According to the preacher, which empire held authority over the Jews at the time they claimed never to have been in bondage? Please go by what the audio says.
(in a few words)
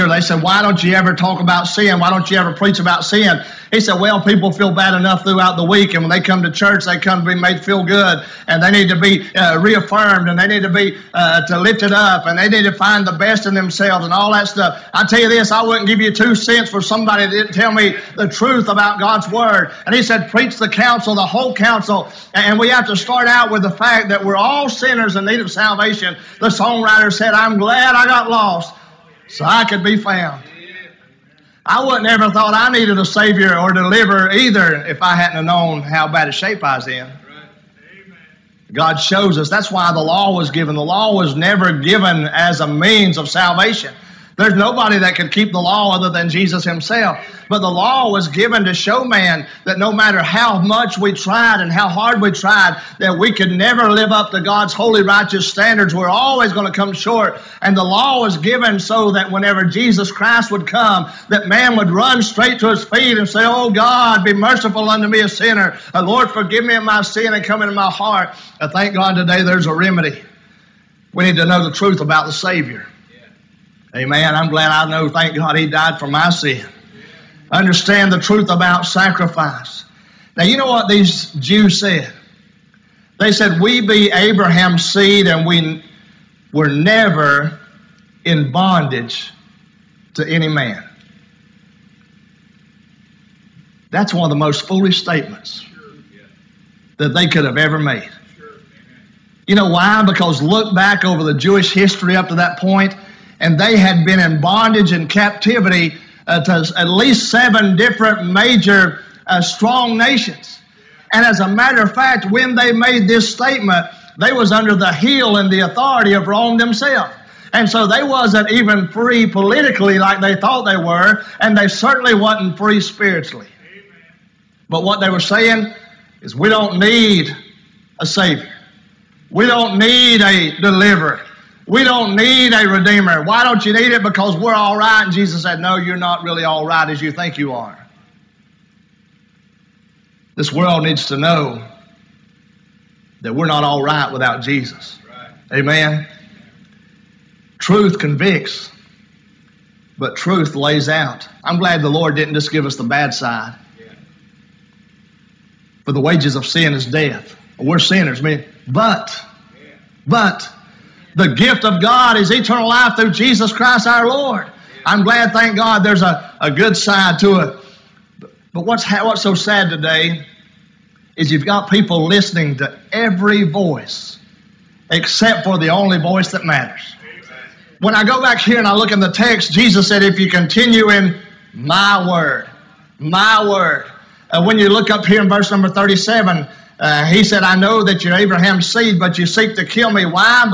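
Rome.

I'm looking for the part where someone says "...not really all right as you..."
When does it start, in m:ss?
2:15.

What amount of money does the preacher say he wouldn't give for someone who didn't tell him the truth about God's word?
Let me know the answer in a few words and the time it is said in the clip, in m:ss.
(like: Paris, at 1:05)
two cents, at 0:16.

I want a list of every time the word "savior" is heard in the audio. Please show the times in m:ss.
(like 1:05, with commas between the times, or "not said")
0:33, 1:12, 2:08.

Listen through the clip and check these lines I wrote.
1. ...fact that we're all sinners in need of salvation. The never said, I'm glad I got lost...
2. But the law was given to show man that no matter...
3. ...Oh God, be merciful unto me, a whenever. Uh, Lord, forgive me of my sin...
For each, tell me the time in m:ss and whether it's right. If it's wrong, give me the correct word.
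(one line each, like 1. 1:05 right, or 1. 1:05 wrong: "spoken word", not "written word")
1. 0:23 wrong: "songwriter", not "never"
2. 0:47 right
3. 1:03 wrong: "sinner", not "whenever".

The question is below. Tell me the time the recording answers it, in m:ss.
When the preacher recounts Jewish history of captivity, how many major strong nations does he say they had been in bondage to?
1:47.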